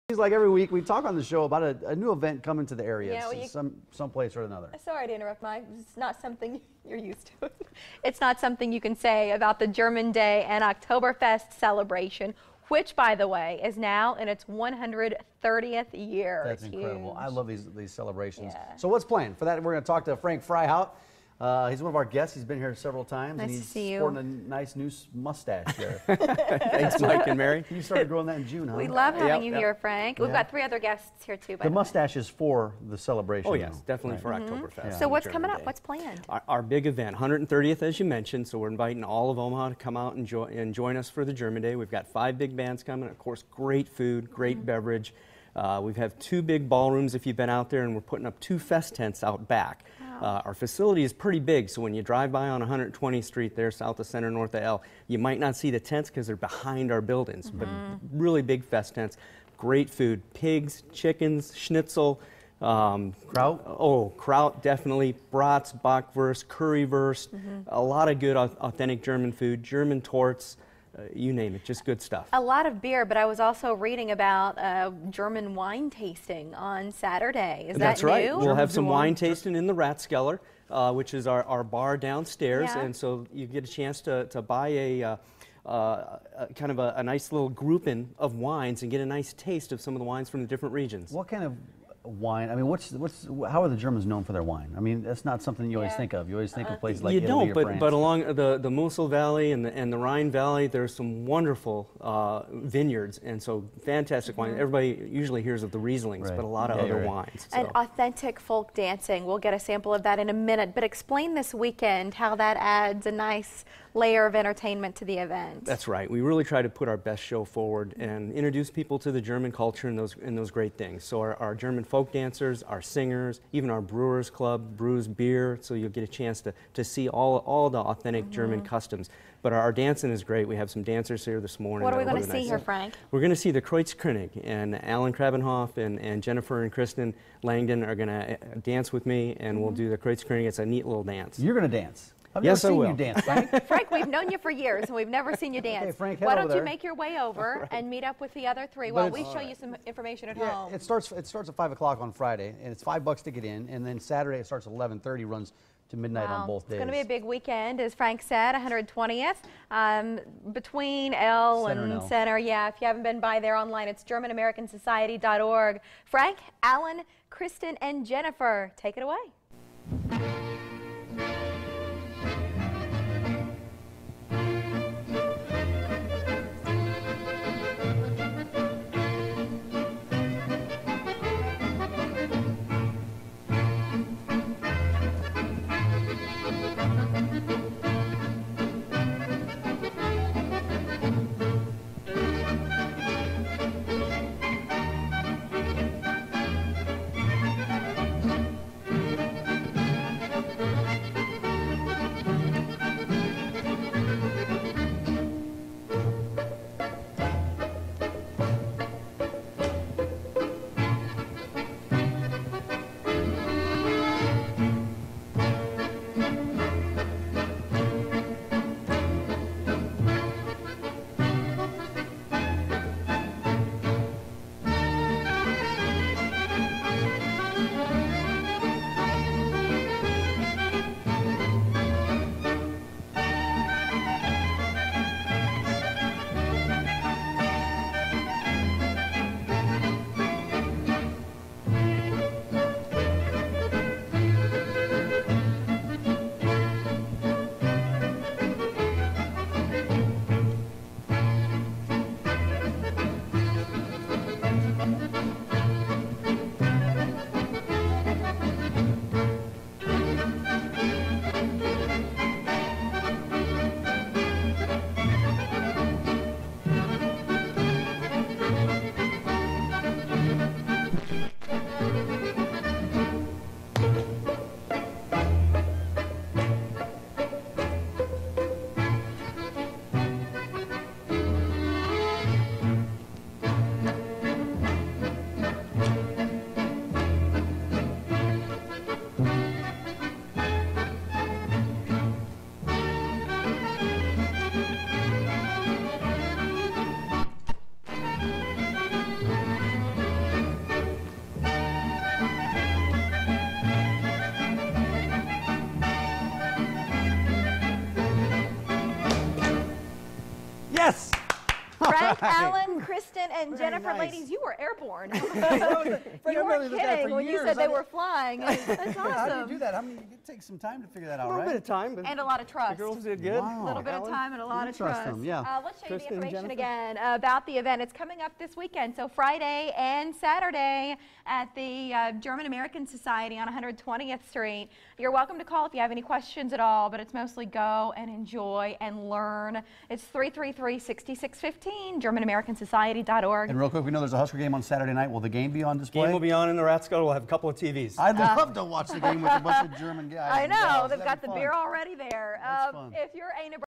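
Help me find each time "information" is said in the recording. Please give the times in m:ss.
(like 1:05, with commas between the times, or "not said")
2:29, 5:26.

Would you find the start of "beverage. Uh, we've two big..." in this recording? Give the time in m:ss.
0:44.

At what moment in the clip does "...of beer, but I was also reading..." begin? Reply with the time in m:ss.
1:12.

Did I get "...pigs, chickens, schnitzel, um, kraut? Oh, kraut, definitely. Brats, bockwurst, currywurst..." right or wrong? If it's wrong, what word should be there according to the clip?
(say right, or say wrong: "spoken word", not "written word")
right.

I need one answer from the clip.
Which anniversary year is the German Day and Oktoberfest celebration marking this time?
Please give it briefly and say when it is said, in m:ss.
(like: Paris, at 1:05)
130th, at 0:14.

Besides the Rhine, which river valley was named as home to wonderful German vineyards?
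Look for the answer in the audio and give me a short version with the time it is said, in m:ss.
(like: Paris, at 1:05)
Mosel Valley, at 1:38.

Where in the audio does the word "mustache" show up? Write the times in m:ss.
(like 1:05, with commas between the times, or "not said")
0:25, 0:31.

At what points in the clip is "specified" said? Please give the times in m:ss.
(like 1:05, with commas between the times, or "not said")
not said.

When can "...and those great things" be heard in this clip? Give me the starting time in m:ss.
2:00.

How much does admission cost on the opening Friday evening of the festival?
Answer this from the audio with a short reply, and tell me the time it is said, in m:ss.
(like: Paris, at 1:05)
$5, at 2:32.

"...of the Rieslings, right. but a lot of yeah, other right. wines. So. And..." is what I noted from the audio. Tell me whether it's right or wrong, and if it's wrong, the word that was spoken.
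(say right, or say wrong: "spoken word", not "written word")
right.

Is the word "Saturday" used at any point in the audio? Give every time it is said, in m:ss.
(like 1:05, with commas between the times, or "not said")
1:16, 2:33, 5:30, 5:44.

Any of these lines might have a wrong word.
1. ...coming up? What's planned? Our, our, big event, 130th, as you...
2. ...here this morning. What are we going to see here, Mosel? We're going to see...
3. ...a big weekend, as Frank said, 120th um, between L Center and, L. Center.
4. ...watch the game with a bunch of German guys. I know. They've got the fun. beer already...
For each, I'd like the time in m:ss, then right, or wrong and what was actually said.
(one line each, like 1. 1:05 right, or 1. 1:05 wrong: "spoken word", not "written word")
1. 0:35 right
2. 2:11 wrong: "Frank", not "Mosel"
3. 2:37 right
4. 5:48 right.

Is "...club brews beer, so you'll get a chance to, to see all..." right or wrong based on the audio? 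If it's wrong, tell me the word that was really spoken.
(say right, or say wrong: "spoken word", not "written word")
right.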